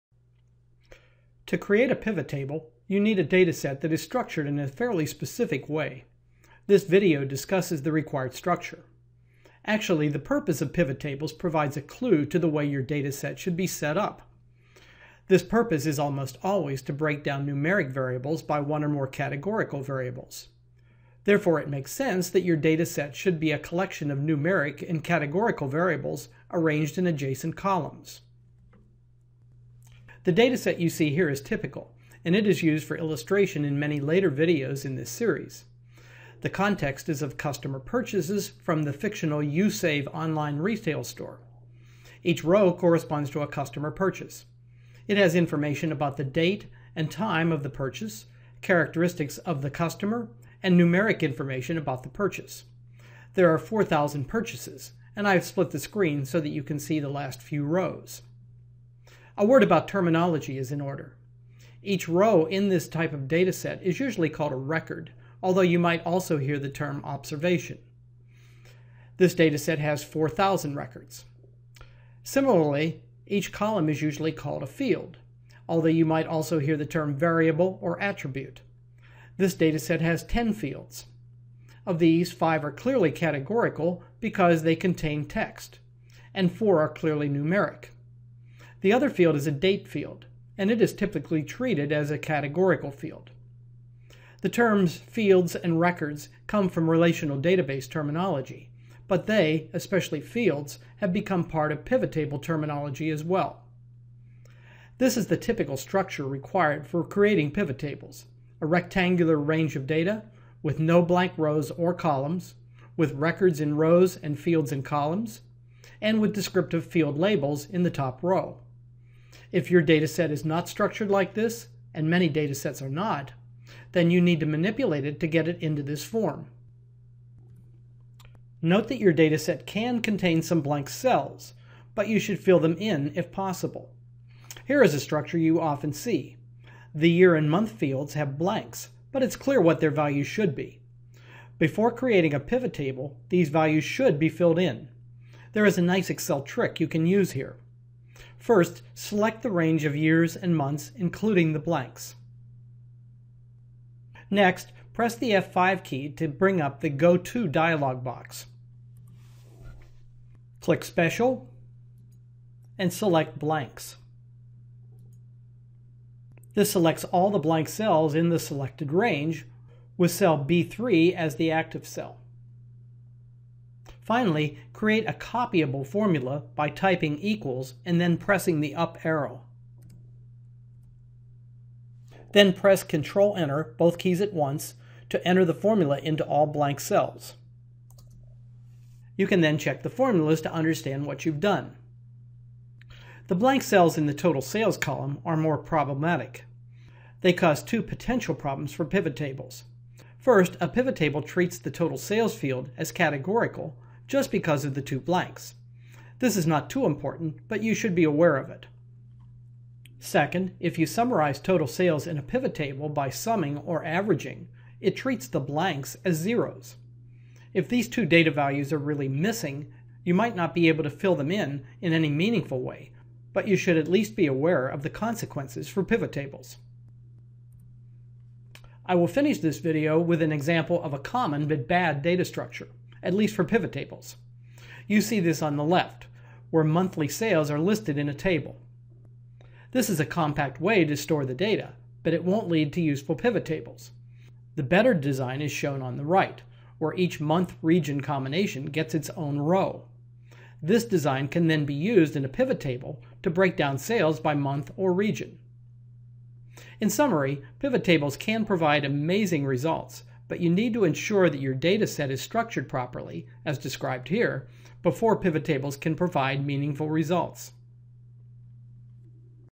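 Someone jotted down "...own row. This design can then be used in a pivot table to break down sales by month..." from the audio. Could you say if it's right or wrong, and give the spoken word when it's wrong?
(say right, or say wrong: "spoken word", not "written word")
right.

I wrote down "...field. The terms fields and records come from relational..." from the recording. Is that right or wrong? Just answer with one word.
right.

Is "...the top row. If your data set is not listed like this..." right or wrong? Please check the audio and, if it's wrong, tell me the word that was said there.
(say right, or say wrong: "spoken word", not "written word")
wrong: "structured", not "listed".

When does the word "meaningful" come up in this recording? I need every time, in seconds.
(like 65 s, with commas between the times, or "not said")
222 s, 266 s.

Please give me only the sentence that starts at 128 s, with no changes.
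Note that your dataset can contain some blank cells, but you should fill them in if possible.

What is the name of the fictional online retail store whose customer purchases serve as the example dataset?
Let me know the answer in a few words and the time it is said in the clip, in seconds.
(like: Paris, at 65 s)
YouSave, at 39 s.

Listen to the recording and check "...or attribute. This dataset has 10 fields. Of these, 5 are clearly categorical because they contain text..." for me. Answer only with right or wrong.
right.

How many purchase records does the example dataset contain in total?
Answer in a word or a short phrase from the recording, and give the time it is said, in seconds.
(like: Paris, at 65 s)
4,000, at 53 s.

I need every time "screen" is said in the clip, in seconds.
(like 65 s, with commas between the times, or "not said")
55 s.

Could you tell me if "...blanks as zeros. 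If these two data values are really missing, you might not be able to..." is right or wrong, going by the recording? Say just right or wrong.
right.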